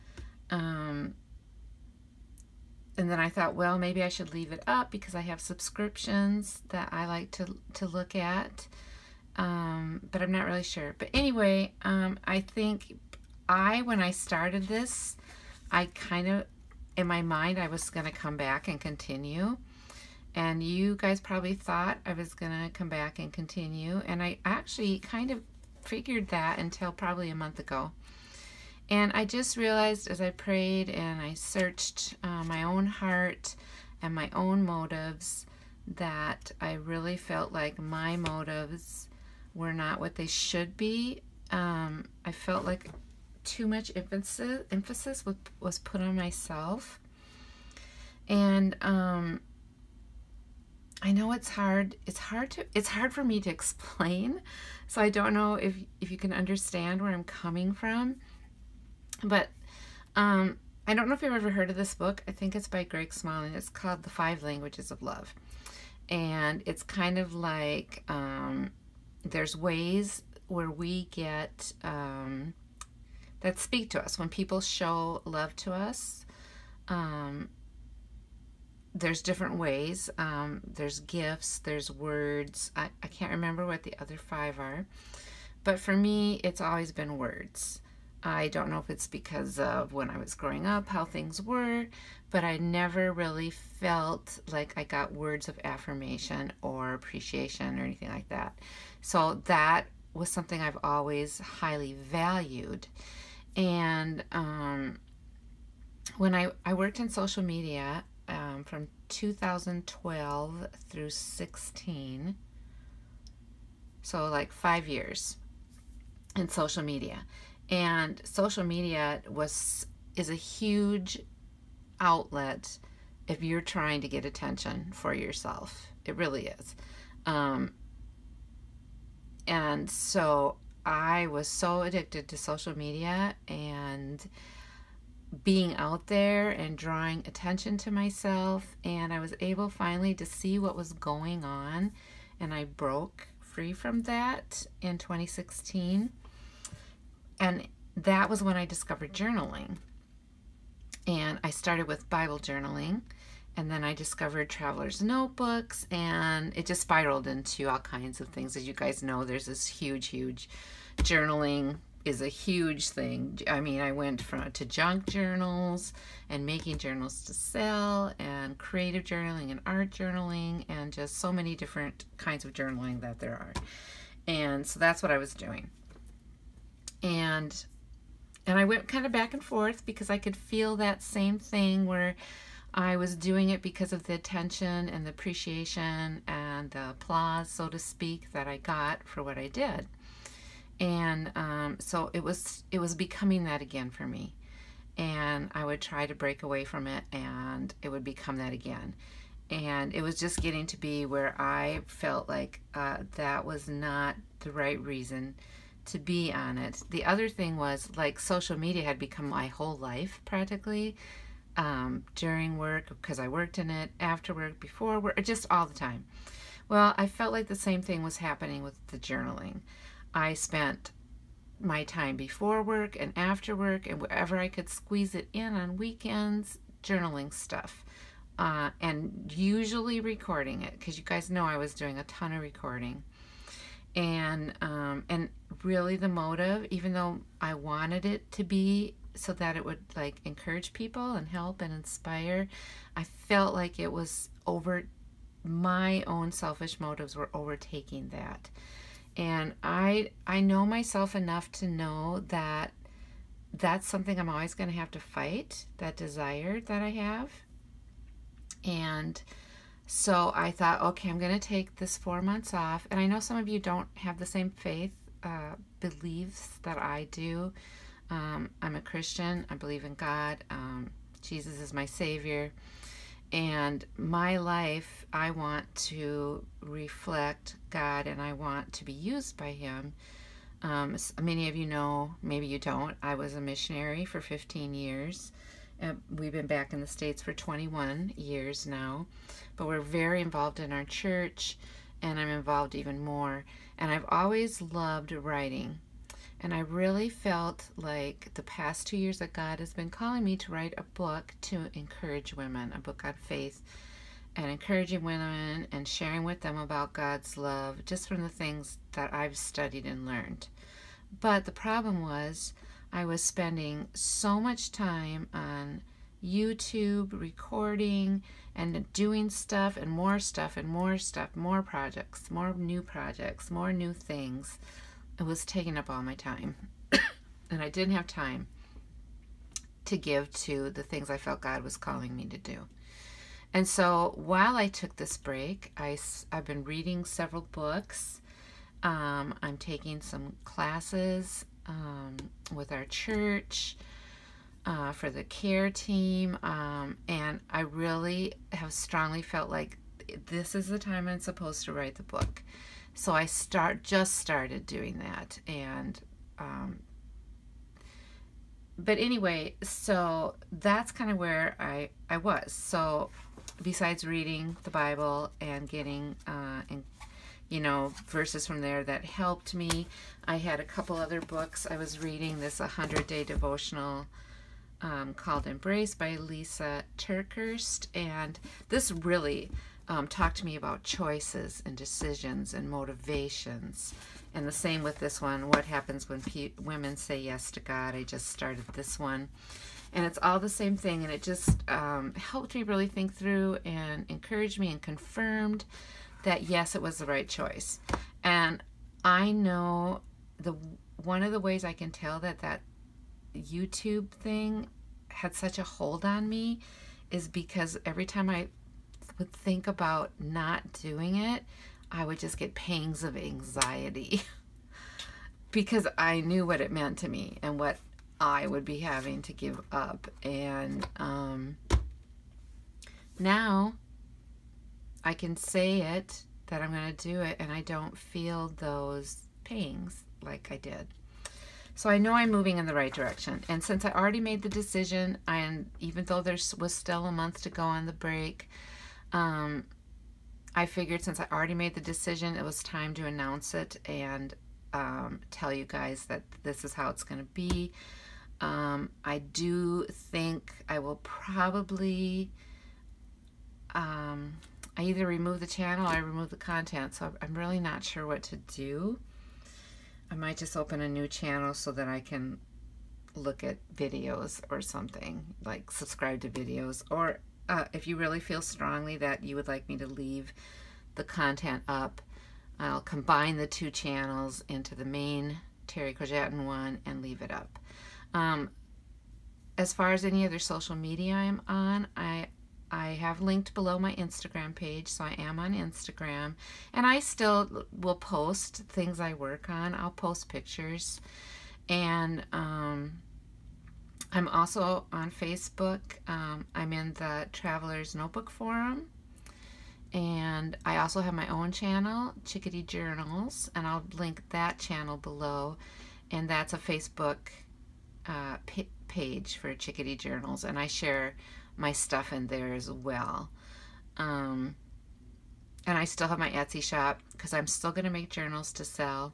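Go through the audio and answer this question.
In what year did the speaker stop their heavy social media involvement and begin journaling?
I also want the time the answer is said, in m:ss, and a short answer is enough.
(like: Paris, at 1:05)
2016, at 2:24.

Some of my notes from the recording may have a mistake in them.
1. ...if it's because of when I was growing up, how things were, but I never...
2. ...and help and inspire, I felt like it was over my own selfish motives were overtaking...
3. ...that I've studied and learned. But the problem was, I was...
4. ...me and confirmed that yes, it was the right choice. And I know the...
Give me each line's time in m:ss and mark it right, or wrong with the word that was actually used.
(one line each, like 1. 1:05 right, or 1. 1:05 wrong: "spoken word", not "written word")
1. 1:28 right
2. 4:01 right
3. 5:08 right
4. 6:34 right.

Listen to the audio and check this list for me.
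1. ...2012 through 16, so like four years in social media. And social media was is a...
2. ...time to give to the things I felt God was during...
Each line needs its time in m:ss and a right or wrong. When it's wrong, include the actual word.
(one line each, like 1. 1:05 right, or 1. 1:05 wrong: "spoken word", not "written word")
1. 1:49 wrong: "five", not "four"
2. 5:28 wrong: "calling", not "during".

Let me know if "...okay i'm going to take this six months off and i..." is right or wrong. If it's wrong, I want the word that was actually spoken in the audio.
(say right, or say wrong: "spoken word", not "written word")
wrong: "four", not "six".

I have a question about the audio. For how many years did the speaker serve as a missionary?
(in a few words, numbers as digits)
15.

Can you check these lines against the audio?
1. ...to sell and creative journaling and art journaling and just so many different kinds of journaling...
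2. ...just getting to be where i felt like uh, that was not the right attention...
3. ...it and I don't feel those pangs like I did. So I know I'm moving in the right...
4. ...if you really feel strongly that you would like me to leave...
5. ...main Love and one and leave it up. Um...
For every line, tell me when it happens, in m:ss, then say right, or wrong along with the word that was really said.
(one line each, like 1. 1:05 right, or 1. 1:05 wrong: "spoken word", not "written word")
1. 2:47 right
2. 3:20 wrong: "reason", not "attention"
3. 7:07 right
4. 7:47 right
5. 7:54 wrong: "Terry", not "Love".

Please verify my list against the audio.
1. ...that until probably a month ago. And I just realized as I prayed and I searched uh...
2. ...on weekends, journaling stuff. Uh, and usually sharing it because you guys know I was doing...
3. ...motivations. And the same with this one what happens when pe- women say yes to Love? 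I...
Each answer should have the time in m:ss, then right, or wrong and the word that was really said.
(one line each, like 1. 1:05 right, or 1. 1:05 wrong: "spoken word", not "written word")
1. 0:26 right
2. 3:45 wrong: "recording", not "sharing"
3. 6:22 wrong: "God", not "Love".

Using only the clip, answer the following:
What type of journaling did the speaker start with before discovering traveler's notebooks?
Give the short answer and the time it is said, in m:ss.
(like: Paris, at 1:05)
Bible journaling, at 2:32.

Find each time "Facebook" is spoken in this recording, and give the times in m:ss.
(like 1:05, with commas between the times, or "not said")
8:15, 8:26.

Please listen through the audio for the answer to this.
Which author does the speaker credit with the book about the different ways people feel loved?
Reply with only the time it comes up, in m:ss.
1:02.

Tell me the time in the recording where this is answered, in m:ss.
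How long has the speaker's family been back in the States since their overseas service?
4:47.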